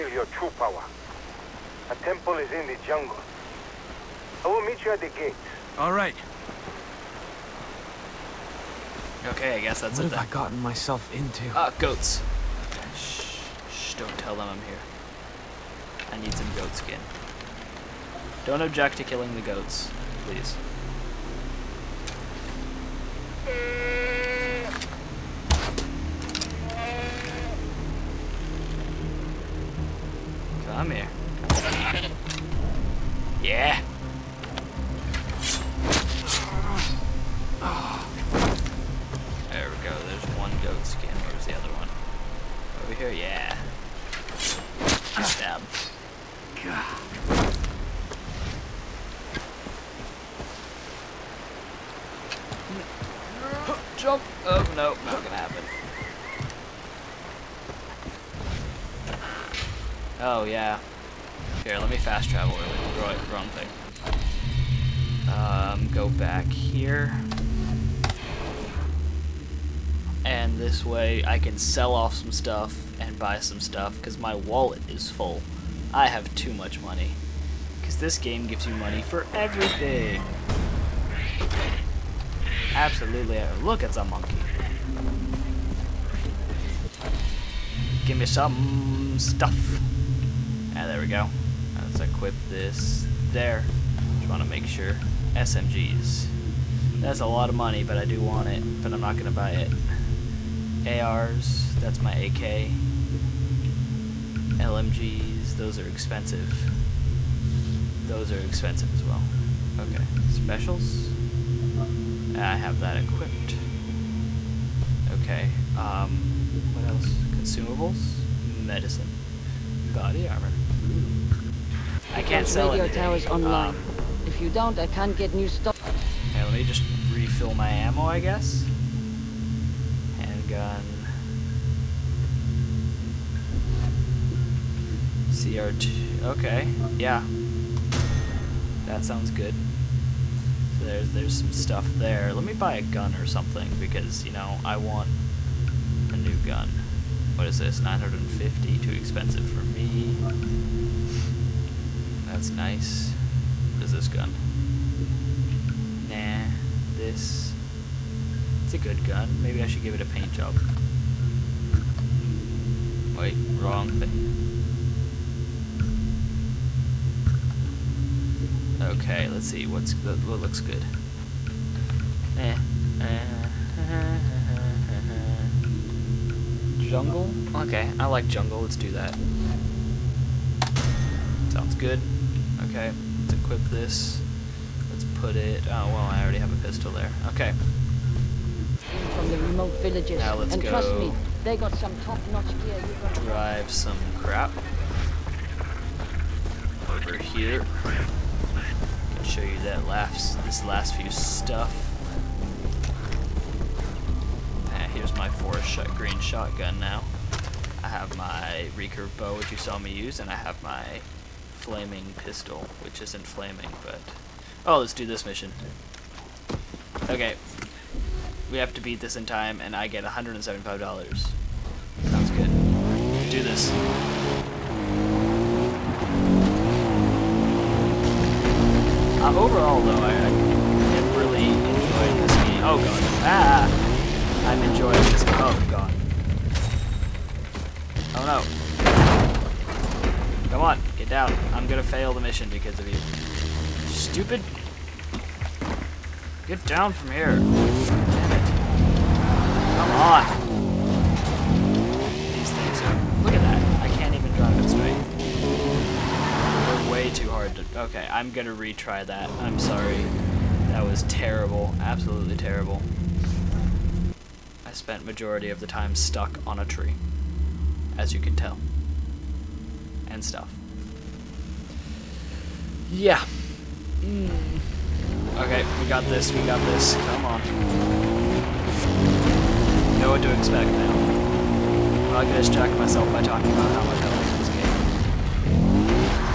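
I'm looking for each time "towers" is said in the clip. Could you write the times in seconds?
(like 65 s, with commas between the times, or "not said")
122 s.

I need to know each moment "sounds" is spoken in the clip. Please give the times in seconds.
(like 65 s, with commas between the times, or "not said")
139 s, 181 s, 222 s.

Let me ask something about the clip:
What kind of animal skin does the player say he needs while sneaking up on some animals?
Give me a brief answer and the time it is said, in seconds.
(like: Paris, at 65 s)
Goat skin, at 16 s.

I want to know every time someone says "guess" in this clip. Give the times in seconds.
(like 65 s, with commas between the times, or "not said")
9 s, 128 s.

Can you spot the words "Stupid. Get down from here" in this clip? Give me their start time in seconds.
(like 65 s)
243 s.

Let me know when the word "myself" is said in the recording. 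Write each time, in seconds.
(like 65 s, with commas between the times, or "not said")
10 s, 282 s.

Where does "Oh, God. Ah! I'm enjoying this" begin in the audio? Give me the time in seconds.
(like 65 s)
232 s.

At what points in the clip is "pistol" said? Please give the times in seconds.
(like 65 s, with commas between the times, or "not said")
186 s, 212 s.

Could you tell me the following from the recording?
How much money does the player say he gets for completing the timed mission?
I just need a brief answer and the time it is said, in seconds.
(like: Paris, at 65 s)
$175, at 220 s.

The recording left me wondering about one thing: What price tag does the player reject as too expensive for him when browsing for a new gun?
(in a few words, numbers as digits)
950.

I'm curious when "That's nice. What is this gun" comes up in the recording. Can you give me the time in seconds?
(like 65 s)
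152 s.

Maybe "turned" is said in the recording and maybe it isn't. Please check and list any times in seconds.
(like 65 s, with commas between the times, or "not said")
not said.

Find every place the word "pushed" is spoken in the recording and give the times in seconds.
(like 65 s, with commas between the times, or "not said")
not said.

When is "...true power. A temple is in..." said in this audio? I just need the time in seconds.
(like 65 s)
0 s.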